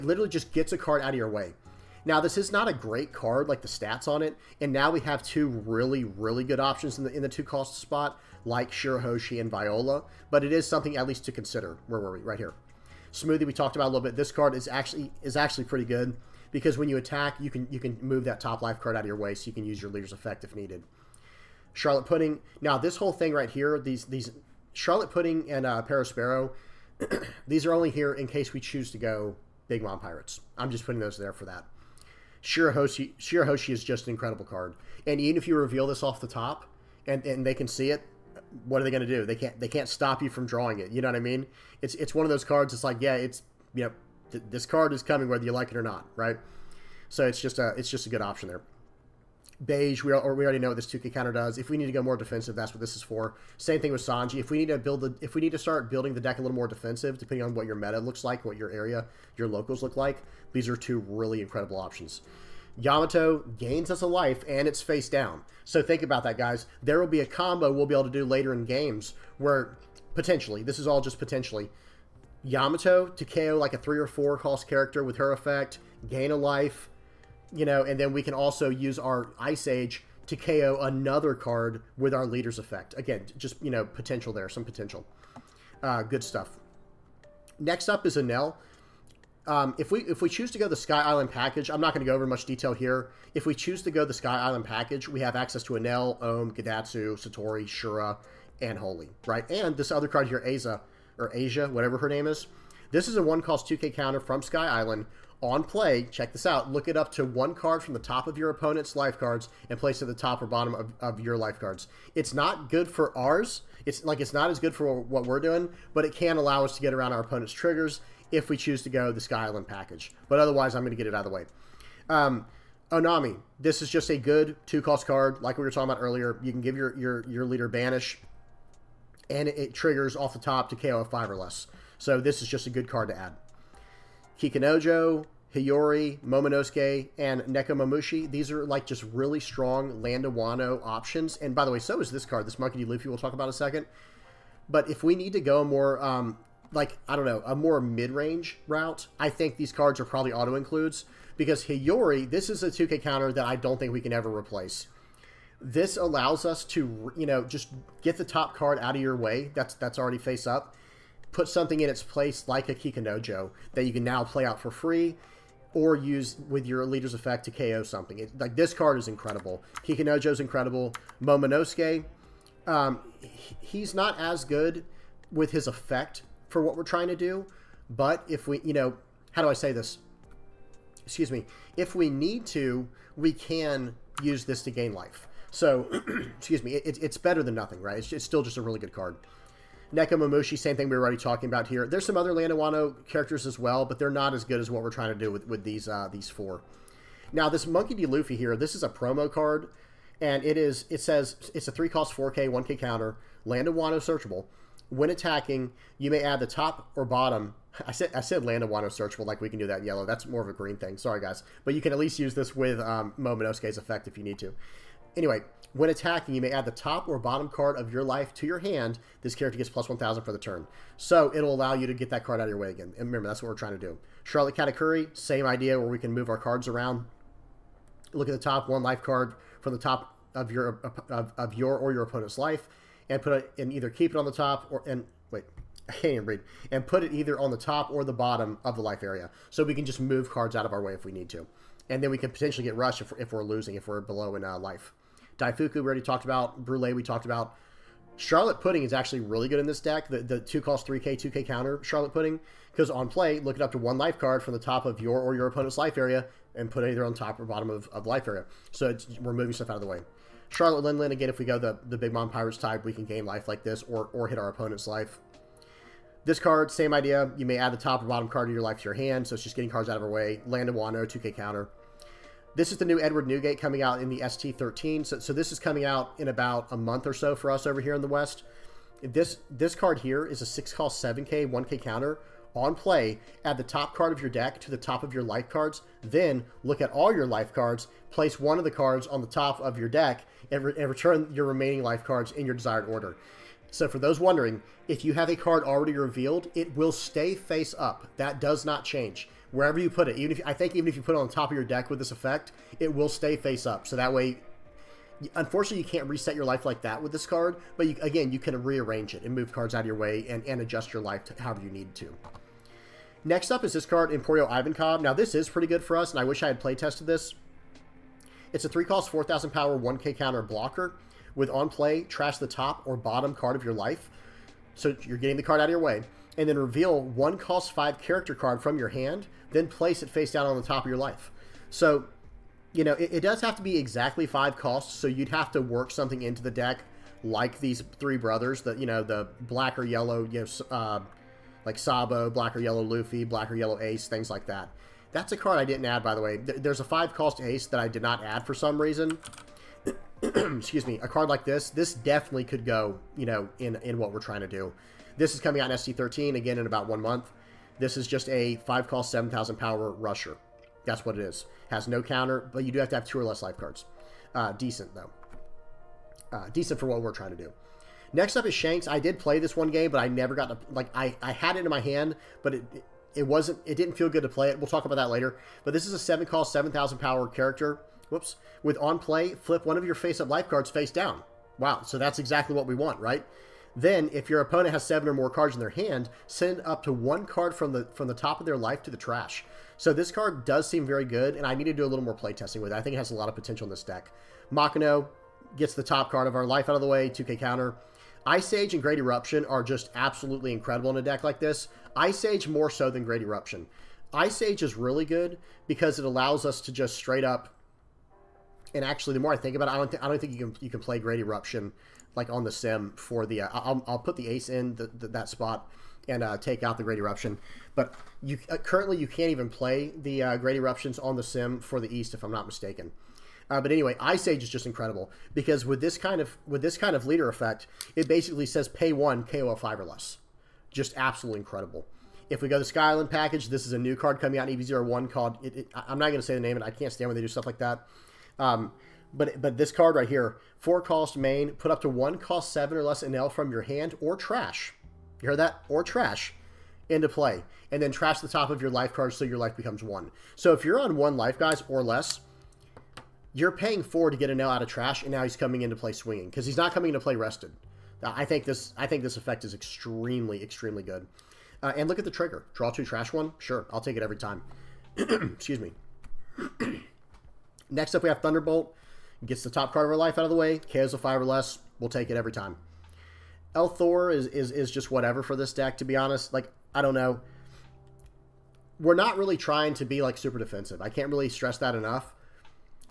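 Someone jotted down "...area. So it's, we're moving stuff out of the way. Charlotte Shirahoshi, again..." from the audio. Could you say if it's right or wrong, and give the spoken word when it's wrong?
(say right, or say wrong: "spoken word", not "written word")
wrong: "Lindland", not "Shirahoshi".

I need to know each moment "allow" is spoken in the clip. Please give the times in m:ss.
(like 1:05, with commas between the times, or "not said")
1:56, 2:35, 3:41, 6:46.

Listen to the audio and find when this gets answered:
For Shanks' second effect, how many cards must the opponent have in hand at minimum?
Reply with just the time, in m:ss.
6:24.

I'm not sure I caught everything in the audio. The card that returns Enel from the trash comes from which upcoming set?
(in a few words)
EB01.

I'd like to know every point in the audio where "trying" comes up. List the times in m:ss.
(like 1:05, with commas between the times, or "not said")
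2:56, 3:14, 3:43, 5:54, 6:07, 7:59.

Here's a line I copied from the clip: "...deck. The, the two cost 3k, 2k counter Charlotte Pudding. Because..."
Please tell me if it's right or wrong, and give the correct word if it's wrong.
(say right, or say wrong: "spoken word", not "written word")
right.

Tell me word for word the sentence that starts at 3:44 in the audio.
Charlotte Katakuri, same idea where we can move our cards around.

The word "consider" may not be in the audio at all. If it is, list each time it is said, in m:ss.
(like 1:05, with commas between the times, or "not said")
0:11.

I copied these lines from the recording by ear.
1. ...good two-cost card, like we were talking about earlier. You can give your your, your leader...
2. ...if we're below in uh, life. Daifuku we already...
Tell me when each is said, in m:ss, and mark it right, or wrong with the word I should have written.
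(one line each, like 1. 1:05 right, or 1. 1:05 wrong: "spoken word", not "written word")
1. 2:04 right
2. 4:03 right.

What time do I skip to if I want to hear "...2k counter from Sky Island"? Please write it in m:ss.
1:43.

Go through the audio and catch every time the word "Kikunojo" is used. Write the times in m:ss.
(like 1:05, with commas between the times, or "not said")
2:14, 2:42.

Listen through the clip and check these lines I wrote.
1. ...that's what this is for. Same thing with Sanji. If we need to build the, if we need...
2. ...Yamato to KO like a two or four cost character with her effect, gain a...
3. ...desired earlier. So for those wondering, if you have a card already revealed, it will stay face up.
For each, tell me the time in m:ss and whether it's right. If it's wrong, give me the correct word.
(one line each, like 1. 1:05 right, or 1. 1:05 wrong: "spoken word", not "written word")
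1. 0:52 right
2. 1:12 wrong: "three", not "two"
3. 4:52 wrong: "order", not "earlier".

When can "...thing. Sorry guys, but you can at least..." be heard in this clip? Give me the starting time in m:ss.
3:30.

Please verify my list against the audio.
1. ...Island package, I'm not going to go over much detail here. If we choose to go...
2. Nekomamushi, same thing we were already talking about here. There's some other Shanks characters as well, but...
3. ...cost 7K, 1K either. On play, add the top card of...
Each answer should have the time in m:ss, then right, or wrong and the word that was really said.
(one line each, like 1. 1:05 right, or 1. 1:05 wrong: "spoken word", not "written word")
1. 1:31 right
2. 3:09 wrong: "Landawano", not "Shanks"
3. 4:40 wrong: "counter", not "either".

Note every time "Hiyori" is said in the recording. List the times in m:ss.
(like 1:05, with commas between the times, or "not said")
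2:15, 2:31.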